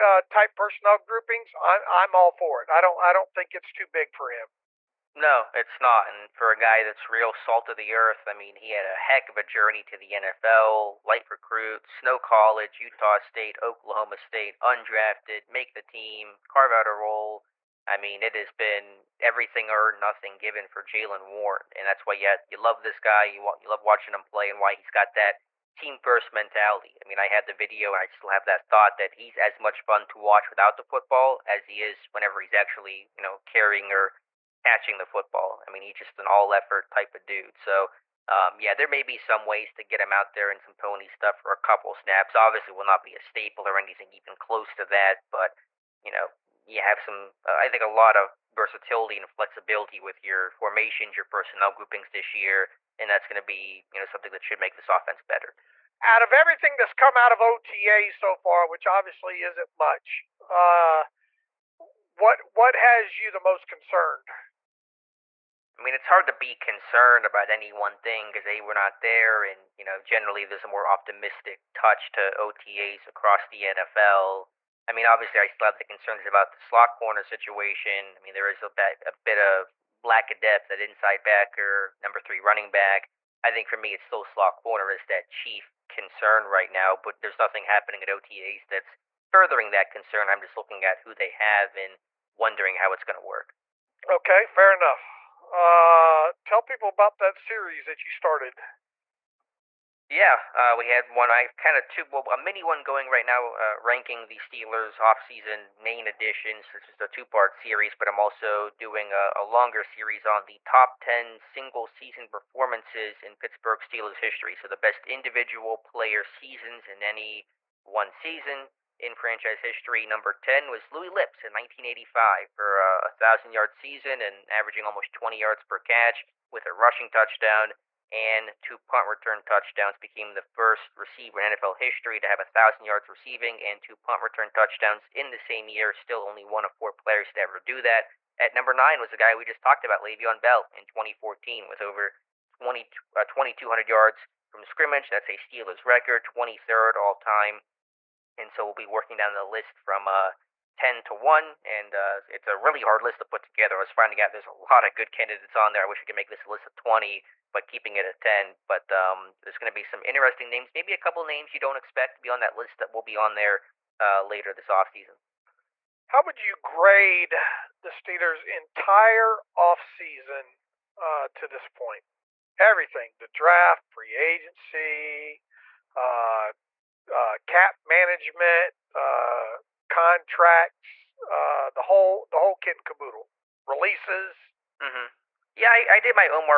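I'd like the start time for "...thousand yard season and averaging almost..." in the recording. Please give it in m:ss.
2:03.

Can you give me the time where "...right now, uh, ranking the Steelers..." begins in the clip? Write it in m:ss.
1:43.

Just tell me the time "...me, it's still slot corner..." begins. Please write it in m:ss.
1:23.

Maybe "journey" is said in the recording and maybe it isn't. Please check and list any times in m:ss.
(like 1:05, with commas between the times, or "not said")
0:09.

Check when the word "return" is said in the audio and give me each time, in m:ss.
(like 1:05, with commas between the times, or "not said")
2:09, 2:14.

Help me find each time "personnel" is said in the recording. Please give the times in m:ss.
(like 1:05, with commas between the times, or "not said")
0:00, 0:51.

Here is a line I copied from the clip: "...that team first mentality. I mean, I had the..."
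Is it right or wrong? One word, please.
right.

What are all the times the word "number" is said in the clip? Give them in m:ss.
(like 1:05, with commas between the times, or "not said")
1:21, 2:00, 2:18.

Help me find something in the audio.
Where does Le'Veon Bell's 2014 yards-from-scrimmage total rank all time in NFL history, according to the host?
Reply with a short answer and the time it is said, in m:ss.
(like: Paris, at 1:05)
23rd, at 2:26.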